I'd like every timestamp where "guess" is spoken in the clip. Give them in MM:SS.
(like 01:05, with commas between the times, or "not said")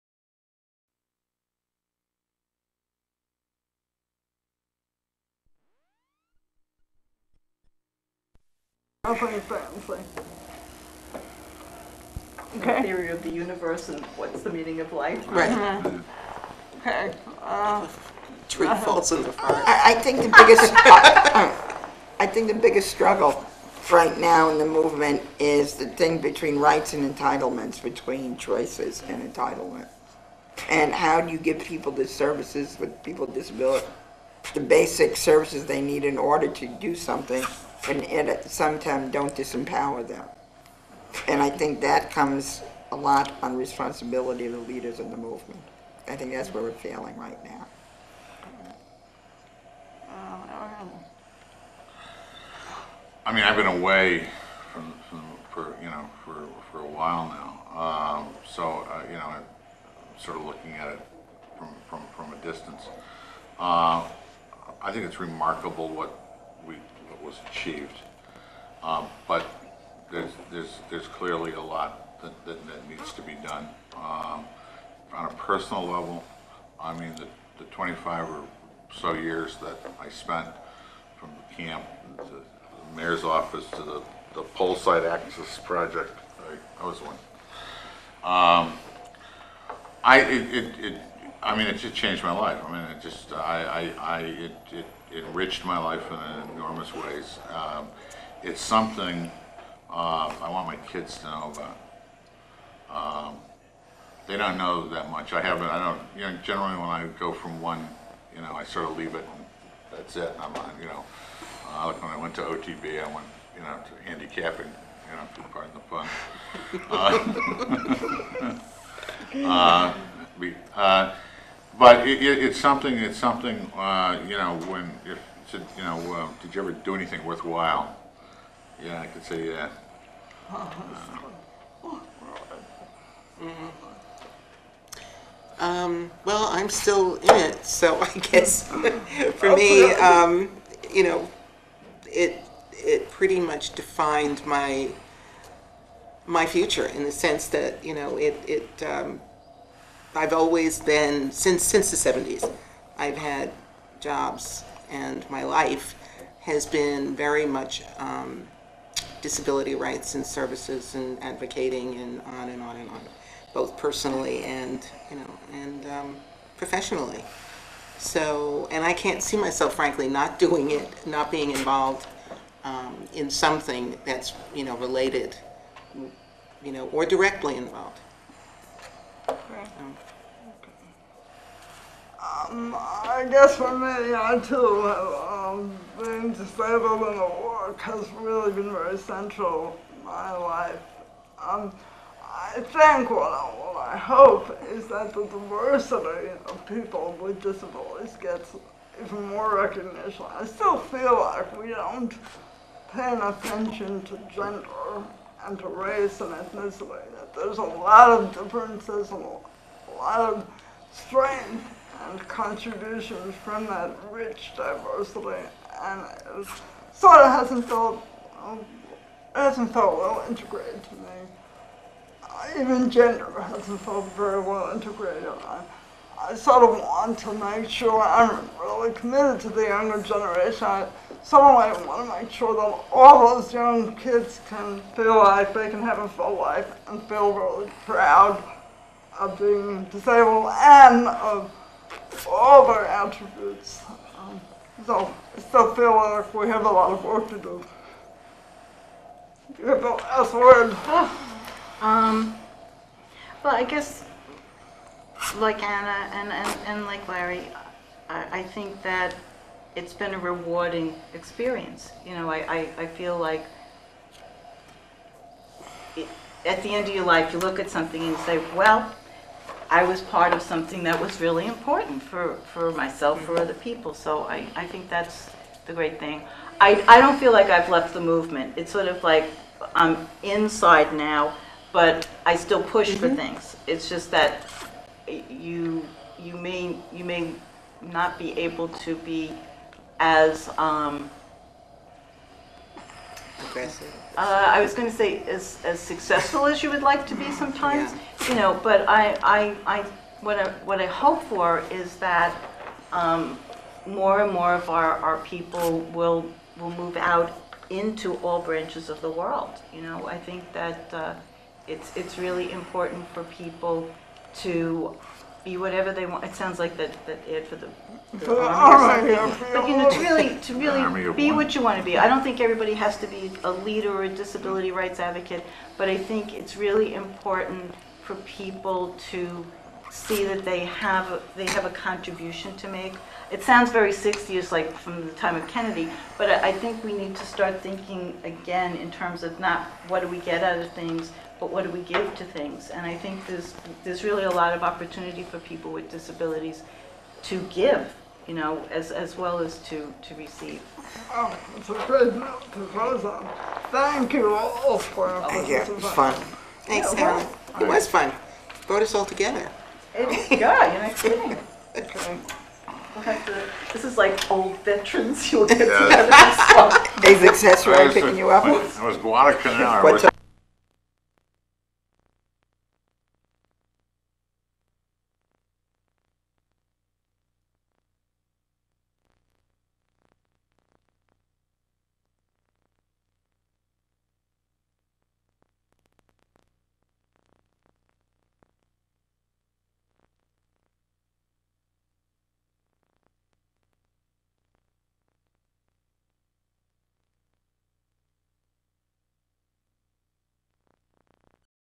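02:18, 03:03, 04:13.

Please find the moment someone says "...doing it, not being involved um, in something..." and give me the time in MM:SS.
02:50.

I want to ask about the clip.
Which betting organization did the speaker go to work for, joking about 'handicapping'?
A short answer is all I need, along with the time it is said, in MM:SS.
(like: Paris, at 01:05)
OTB, at 01:52.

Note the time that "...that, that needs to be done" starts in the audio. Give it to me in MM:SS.
01:12.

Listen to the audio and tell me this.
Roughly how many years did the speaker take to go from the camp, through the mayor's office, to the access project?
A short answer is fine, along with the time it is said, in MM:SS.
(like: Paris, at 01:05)
25, at 01:17.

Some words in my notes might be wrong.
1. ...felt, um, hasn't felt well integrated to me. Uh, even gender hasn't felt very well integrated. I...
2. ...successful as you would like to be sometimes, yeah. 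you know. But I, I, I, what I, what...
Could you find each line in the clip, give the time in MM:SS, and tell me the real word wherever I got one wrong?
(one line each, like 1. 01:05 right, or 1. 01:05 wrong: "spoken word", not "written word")
1. 03:37 right
2. 04:55 right.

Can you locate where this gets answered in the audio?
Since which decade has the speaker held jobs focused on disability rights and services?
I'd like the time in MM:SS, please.
02:31.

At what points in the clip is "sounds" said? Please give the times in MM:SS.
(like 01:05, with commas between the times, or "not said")
05:16, 05:33.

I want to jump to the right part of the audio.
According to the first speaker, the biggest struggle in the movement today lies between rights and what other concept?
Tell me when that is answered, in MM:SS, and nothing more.
00:27.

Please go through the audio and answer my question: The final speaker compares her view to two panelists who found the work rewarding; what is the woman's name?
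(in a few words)
Anna.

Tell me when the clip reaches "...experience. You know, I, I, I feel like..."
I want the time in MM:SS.
04:21.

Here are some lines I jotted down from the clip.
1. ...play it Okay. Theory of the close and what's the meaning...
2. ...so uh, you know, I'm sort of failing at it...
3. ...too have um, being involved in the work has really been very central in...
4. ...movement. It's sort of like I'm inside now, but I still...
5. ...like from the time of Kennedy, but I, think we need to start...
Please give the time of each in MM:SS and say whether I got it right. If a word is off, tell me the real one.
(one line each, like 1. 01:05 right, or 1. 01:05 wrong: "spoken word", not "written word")
1. 00:09 wrong: "universe", not "close"
2. 00:58 wrong: "looking", not "failing"
3. 03:04 wrong: "disabled", not "involved"
4. 04:38 right
5. 05:34 right.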